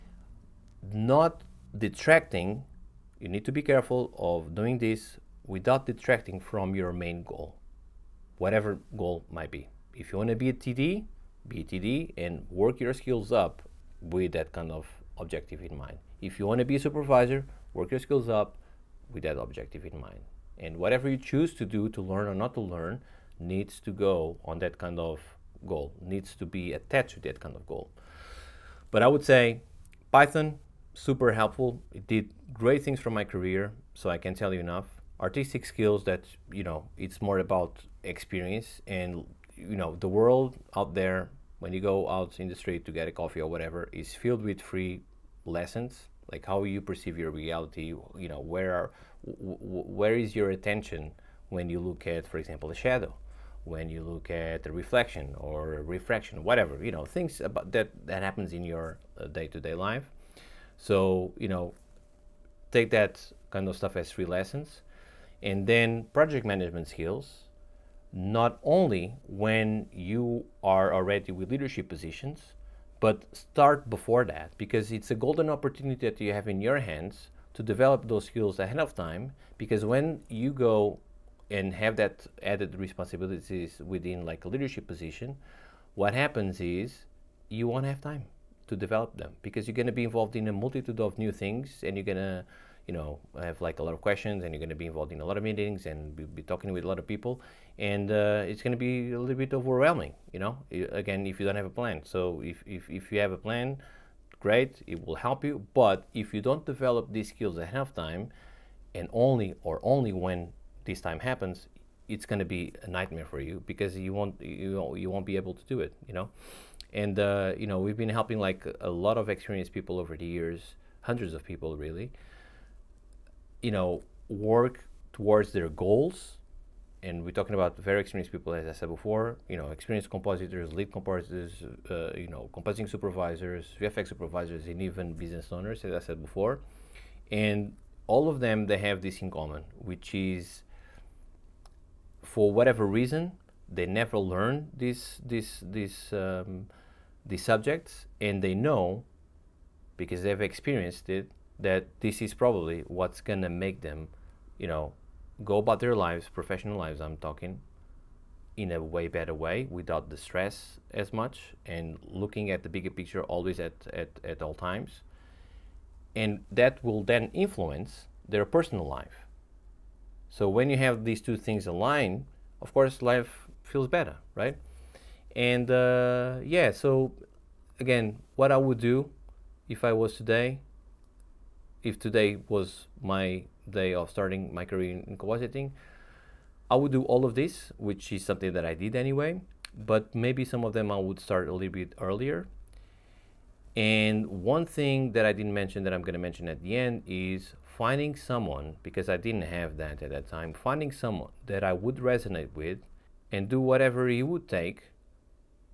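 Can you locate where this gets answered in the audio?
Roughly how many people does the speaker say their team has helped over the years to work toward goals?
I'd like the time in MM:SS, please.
02:01.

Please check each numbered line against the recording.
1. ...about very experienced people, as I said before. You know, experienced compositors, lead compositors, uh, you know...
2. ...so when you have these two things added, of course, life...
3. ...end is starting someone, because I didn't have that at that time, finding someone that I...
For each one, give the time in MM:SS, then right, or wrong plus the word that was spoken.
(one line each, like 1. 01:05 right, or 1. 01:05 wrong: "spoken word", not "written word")
1. 02:07 right
2. 02:50 wrong: "aligned", not "added"
3. 03:16 wrong: "finding", not "starting".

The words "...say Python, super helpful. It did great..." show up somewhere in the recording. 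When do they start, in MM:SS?
00:29.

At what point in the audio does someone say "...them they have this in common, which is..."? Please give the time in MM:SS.
02:18.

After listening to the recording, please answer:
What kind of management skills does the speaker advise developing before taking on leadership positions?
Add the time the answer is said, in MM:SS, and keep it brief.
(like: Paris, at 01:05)
project management, at 01:06.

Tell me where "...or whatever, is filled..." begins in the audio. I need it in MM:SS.
00:43.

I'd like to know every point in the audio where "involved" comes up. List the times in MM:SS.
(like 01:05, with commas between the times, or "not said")
01:30, 01:34.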